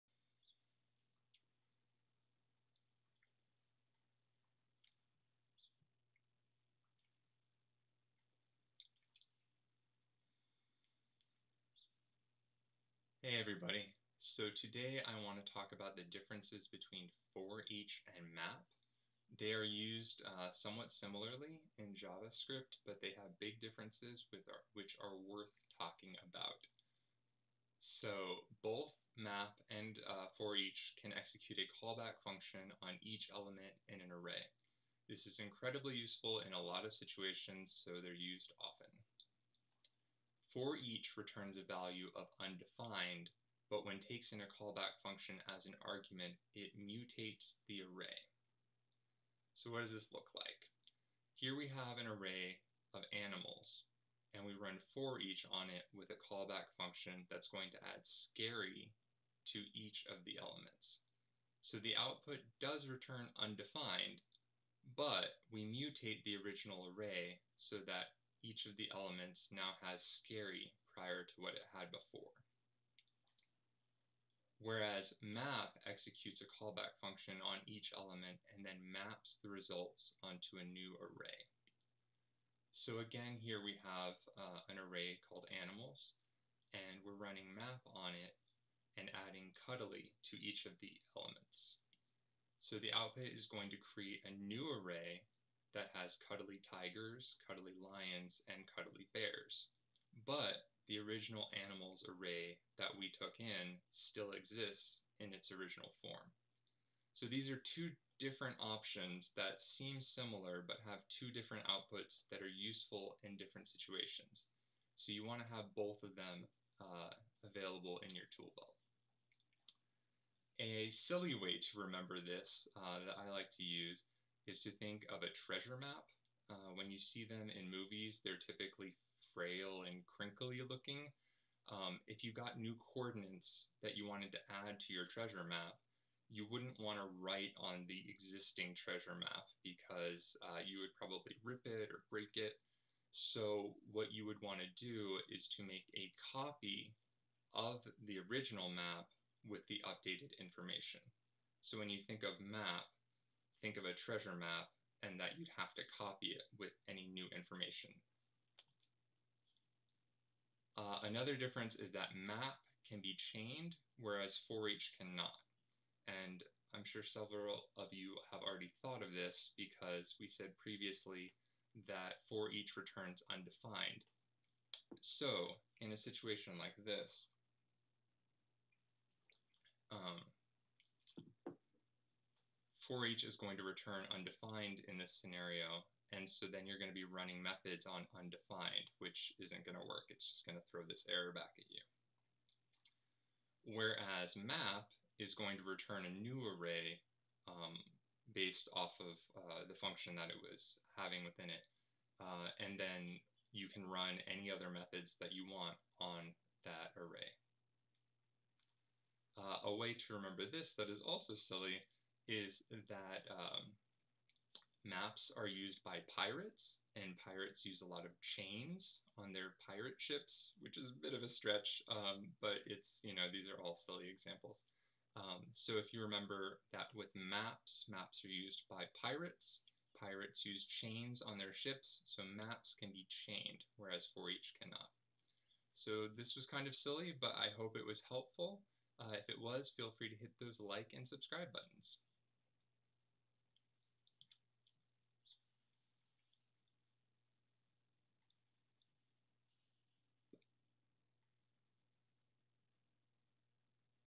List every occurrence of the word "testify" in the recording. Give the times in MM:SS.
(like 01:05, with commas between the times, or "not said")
not said.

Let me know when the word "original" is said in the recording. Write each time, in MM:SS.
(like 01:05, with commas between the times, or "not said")
01:06, 01:40, 01:45, 02:28.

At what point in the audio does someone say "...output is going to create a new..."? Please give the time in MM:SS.
01:32.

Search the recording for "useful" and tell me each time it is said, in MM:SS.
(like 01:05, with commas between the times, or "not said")
00:35, 01:52.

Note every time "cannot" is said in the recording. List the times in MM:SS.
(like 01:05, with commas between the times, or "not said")
02:44, 03:54.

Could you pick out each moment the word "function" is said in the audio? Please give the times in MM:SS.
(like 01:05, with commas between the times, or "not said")
00:32, 00:44, 00:56, 01:17, 03:19.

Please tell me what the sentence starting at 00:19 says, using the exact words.
They are used uh, somewhat similarly in JavaScript, but they have big differences with our, which are worth talking about.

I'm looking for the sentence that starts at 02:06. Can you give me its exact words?
Uh, when you see them in movies, they're typically frail and crinkly looking.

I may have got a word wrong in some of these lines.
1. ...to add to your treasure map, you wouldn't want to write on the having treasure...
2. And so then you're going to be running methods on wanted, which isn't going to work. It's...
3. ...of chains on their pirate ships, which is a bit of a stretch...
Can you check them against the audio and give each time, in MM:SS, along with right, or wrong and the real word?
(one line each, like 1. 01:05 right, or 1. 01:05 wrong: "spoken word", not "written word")
1. 02:14 wrong: "existing", not "having"
2. 03:06 wrong: "undefined", not "wanted"
3. 03:38 right.